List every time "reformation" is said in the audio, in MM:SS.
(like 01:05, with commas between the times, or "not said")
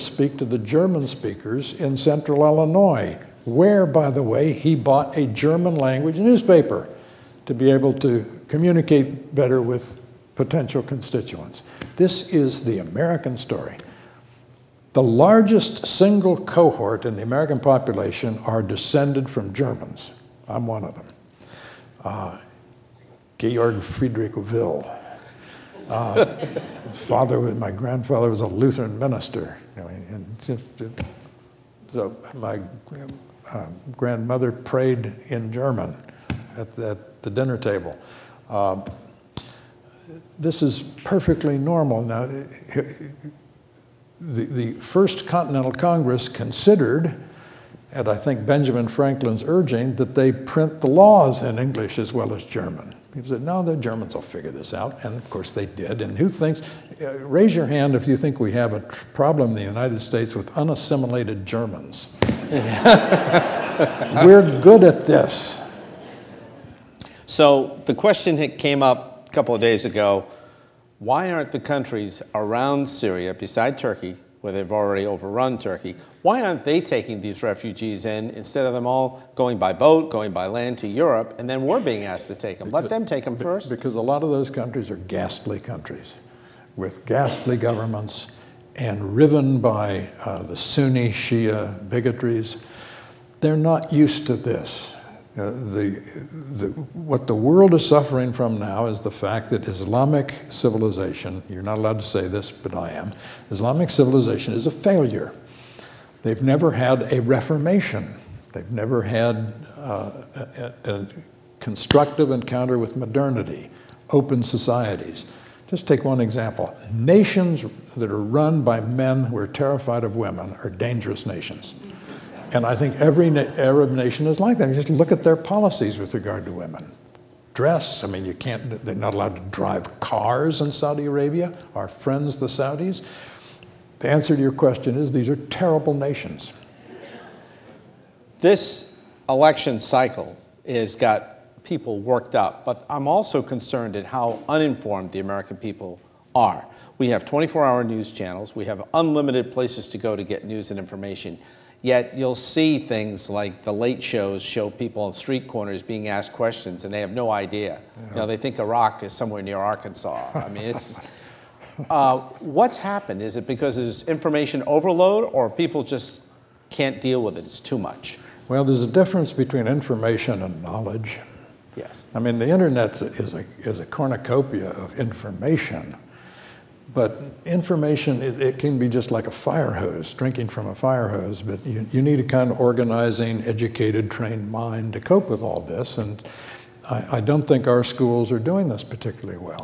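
01:47.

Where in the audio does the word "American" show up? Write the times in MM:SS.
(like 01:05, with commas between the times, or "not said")
00:12, 00:17, 02:25.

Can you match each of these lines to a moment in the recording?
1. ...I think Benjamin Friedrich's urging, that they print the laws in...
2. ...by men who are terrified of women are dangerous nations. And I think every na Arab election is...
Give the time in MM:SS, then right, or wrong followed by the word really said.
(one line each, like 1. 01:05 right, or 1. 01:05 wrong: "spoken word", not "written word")
1. 00:48 wrong: "Franklin", not "Friedrich"
2. 01:58 wrong: "nation", not "election".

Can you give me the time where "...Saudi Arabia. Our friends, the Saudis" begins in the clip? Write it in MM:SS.
02:10.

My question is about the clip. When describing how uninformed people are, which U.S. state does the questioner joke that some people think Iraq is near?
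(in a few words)
Arkansas.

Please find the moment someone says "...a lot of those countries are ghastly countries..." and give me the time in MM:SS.
01:23.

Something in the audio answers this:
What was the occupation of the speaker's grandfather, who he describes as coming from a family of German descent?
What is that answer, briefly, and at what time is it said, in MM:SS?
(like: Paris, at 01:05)
Lutheran minister, at 00:28.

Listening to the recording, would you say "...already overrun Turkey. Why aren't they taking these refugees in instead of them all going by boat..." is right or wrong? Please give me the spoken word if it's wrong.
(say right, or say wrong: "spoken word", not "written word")
right.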